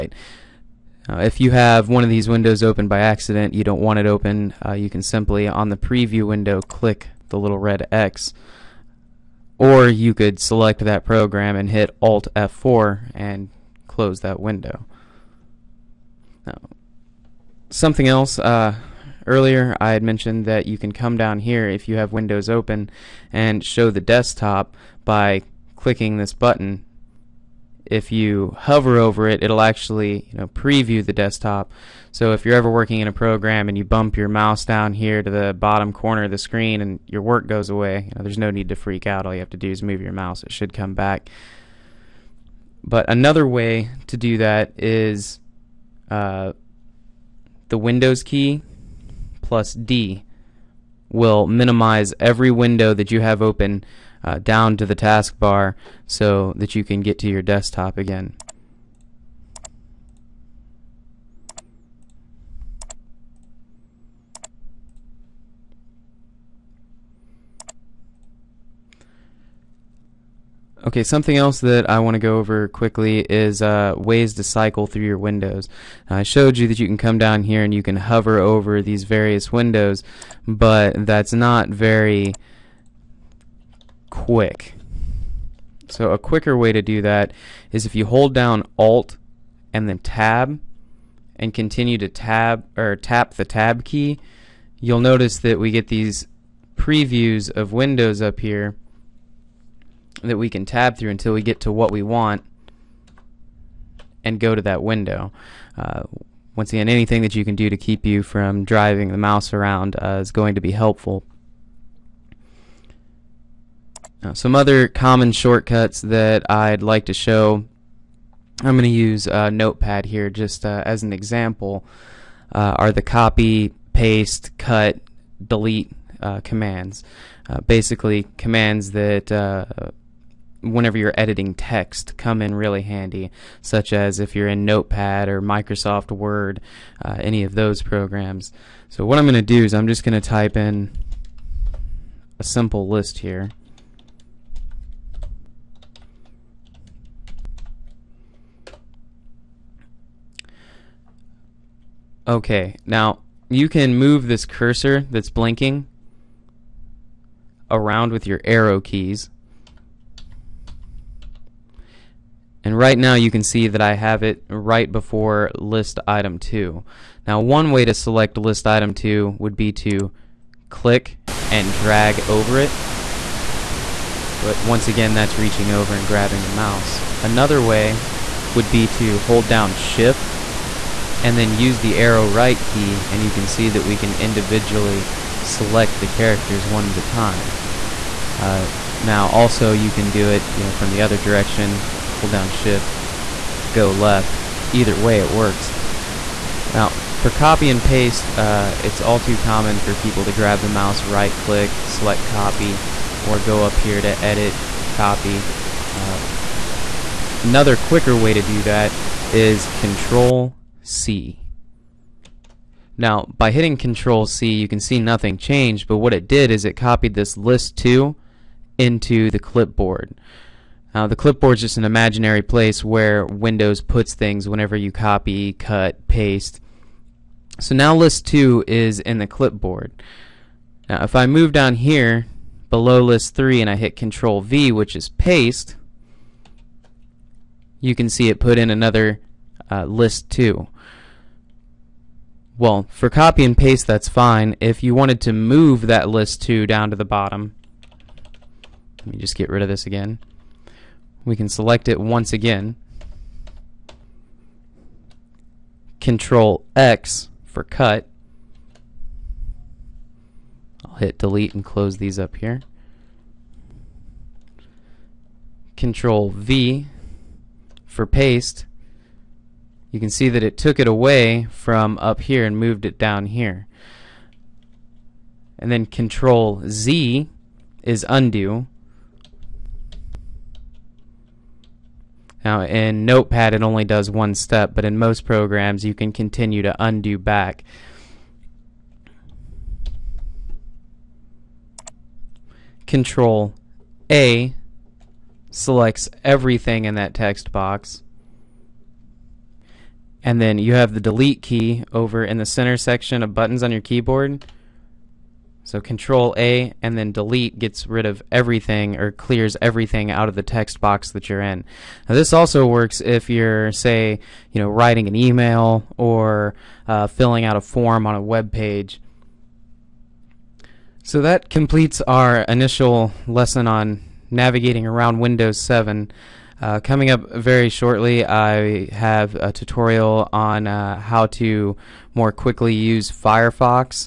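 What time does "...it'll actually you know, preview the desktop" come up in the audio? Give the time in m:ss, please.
0:29.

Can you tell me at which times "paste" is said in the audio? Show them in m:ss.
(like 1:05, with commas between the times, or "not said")
2:03, 3:17, 3:46, 3:55, 4:03, 4:28.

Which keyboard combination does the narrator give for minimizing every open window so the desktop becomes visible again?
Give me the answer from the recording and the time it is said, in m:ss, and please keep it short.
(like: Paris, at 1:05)
Windows key plus D, at 0:47.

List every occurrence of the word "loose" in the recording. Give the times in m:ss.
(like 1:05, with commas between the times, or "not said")
not said.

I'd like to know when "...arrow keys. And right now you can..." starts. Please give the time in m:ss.
2:38.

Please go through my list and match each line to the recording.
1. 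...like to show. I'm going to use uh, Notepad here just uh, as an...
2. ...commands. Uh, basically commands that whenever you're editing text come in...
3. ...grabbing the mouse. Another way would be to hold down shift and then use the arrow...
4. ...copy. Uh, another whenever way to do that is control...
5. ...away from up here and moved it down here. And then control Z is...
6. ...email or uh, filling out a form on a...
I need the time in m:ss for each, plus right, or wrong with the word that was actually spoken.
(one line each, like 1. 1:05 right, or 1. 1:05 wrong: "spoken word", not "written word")
1. 1:56 right
2. 2:06 right
3. 2:56 right
4. 3:24 wrong: "quicker", not "whenever"
5. 4:30 right
6. 5:15 right.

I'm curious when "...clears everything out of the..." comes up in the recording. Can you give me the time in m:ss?
5:09.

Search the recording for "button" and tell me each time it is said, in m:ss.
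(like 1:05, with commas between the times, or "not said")
0:26, 5:03.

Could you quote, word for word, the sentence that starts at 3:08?
Uh, now also you can do it you know from the other direction hold down shift go left either way it works.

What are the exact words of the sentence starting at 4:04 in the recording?
If you wanted to move that list two down to the bottom, let me just get rid of this again.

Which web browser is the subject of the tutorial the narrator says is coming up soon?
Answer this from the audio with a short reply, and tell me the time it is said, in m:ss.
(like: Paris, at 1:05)
Firefox, at 5:33.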